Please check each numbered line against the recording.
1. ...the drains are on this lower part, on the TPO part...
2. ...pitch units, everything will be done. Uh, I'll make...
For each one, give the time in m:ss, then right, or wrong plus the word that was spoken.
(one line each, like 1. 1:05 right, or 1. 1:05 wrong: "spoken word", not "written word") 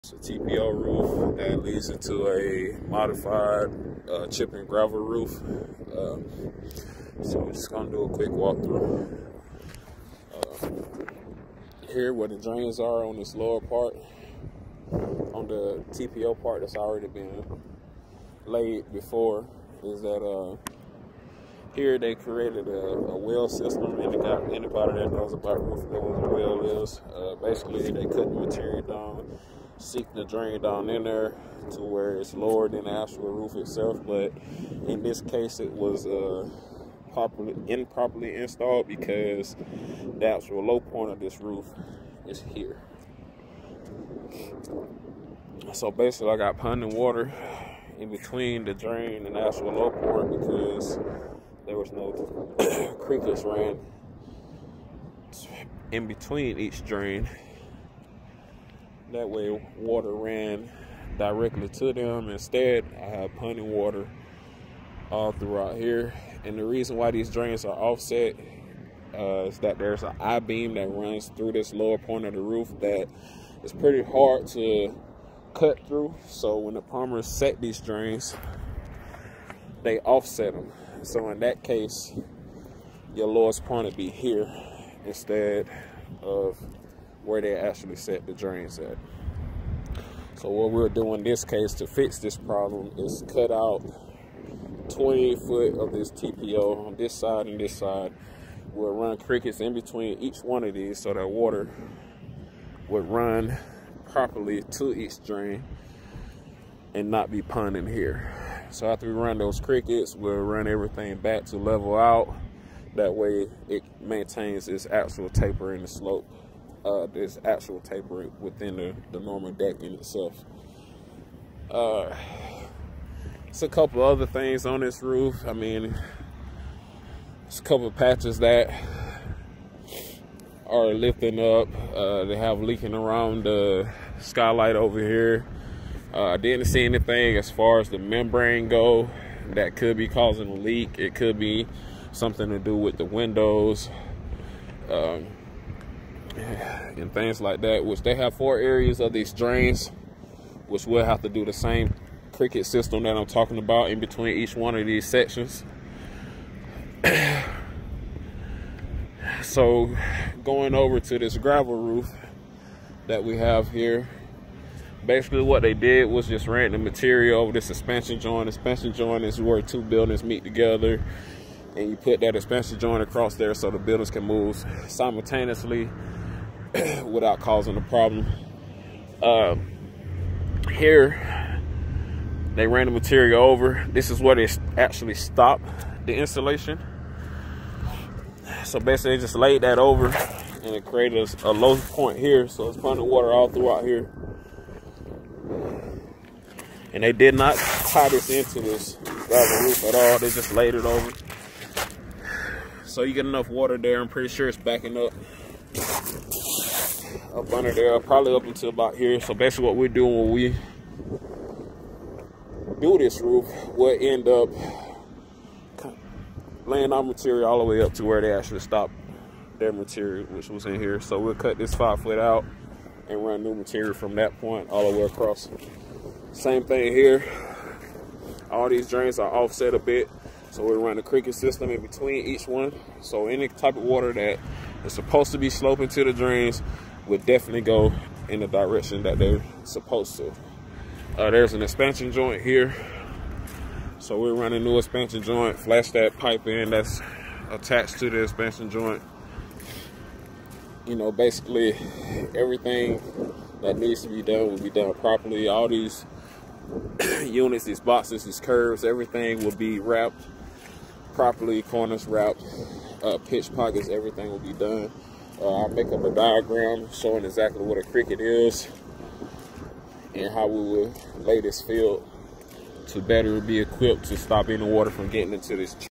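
1. 0:12 right
2. 4:23 wrong: "pockets", not "units".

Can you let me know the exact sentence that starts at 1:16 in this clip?
So when the plumbers set these drains, they offset them.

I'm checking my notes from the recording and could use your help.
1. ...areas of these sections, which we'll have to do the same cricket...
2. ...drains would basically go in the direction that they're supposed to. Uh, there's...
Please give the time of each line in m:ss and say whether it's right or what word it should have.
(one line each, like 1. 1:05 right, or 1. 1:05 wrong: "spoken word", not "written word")
1. 2:28 wrong: "drains", not "sections"
2. 3:56 wrong: "definitely", not "basically".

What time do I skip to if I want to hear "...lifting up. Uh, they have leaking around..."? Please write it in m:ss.
2:10.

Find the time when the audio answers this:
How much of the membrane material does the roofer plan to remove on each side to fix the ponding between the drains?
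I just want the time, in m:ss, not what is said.
1:34.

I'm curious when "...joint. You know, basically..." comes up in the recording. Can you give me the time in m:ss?
4:08.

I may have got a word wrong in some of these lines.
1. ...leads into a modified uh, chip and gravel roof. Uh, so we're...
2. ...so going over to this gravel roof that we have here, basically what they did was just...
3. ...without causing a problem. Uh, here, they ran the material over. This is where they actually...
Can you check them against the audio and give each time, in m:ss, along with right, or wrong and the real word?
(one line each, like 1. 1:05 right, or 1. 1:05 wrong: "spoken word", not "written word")
1. 0:01 right
2. 2:39 right
3. 2:57 right.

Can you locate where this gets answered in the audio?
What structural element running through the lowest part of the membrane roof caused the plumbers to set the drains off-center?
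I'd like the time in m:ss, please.
1:10.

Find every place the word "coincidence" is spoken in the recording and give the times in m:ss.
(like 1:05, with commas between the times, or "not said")
not said.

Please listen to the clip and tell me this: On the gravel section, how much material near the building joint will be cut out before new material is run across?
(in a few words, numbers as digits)
5 foot.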